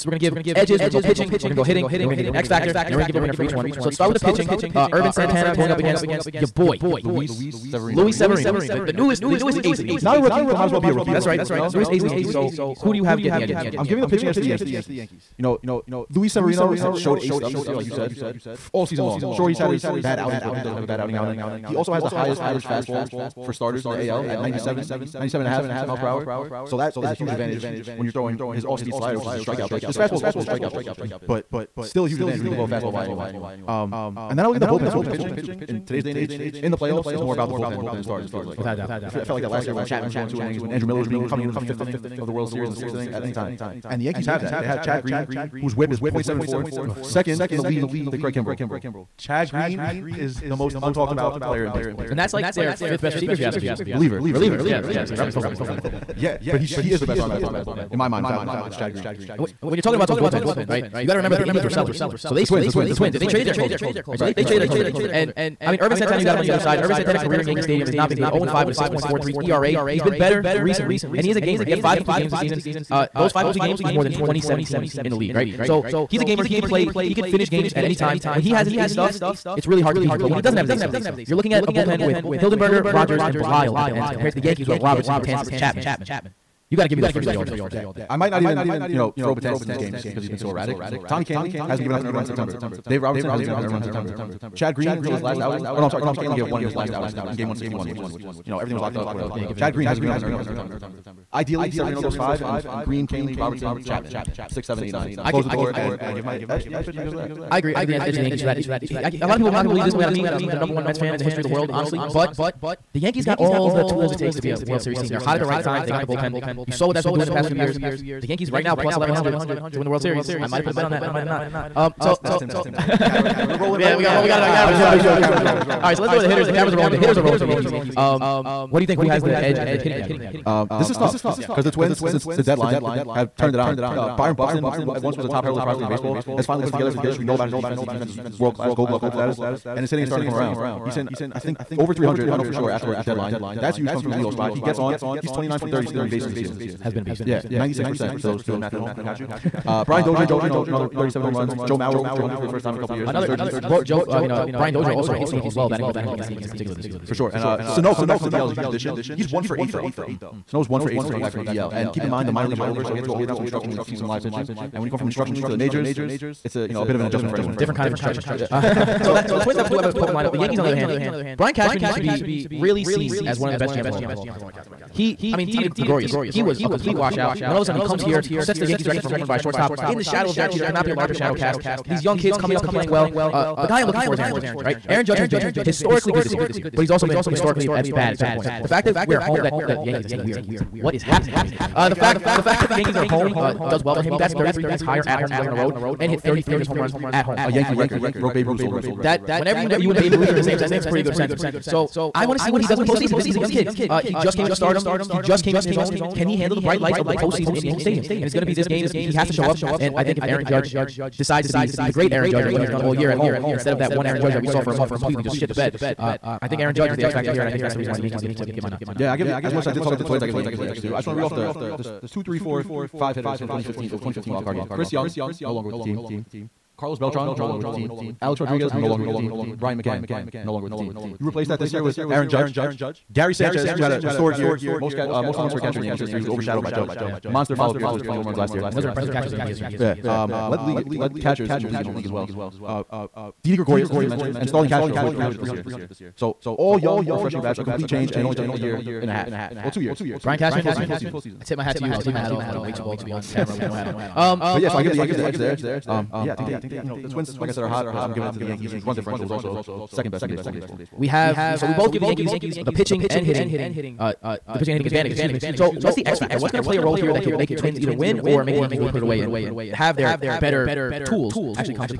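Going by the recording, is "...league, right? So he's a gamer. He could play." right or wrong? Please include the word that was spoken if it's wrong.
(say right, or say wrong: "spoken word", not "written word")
right.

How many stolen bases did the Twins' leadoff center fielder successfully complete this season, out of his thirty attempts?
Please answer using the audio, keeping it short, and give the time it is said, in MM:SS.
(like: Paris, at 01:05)
29, at 02:25.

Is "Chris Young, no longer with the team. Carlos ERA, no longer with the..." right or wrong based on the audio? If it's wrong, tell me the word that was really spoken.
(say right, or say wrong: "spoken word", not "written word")
wrong: "Beltran", not "ERA".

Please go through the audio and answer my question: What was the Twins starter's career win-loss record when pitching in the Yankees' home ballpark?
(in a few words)
0-5.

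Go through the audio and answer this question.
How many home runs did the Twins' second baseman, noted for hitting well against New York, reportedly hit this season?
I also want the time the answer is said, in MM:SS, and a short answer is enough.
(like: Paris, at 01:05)
37, at 02:30.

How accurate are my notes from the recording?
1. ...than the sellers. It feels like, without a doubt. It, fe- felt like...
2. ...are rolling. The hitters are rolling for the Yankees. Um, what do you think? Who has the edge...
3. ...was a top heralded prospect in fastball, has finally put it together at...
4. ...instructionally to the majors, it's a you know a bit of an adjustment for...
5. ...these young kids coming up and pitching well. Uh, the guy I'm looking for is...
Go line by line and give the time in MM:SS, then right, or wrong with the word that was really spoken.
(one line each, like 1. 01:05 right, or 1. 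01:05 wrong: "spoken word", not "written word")
1. 00:37 wrong: "stars", not "sellers"
2. 02:06 right
3. 02:15 wrong: "baseball", not "fastball"
4. 02:45 right
5. 03:01 wrong: "playing", not "pitching".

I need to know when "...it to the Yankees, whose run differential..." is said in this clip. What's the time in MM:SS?
04:18.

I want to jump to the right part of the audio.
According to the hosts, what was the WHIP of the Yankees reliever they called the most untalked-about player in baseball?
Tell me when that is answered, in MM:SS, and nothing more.
00:46.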